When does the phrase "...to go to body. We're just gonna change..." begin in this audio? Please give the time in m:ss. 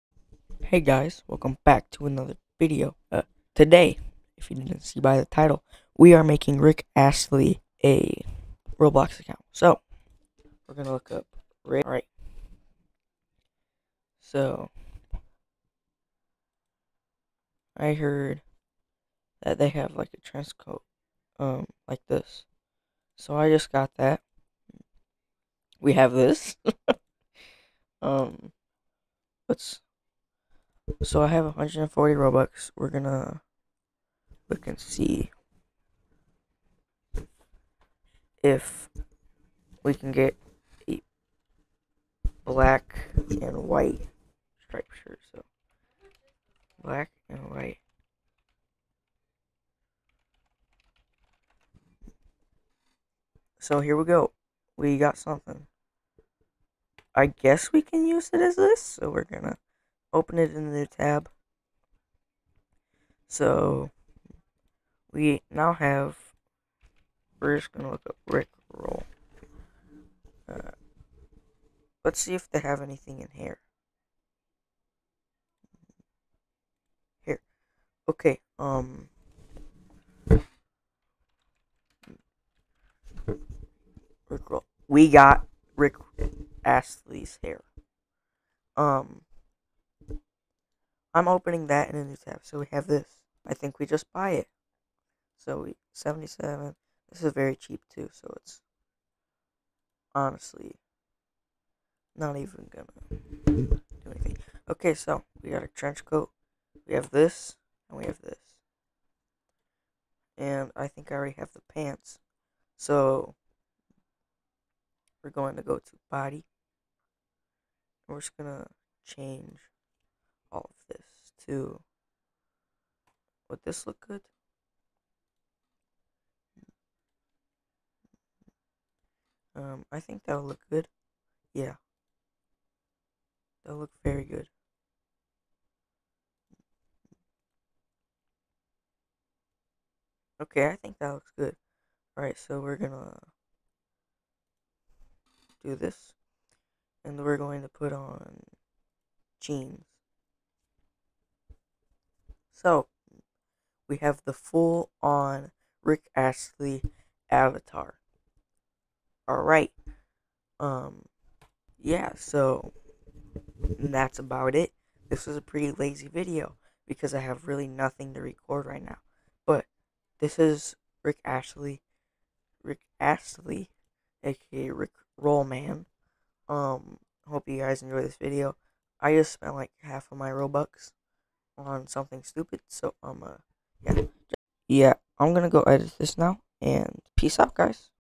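1:55.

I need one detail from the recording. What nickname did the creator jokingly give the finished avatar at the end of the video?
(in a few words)
Rick Rollman.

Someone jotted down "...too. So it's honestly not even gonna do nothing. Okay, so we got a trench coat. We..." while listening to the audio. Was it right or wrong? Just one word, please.
wrong.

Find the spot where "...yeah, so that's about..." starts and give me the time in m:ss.
2:41.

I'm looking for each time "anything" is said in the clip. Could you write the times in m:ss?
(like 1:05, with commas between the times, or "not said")
1:12, 1:44.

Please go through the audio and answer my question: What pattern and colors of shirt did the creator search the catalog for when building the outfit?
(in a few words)
Black and white striped.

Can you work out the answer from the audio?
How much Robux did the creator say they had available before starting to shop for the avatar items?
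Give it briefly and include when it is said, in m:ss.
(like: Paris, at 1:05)
140, at 0:31.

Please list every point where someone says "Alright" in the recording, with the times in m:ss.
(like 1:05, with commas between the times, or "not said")
0:11, 2:22, 2:39.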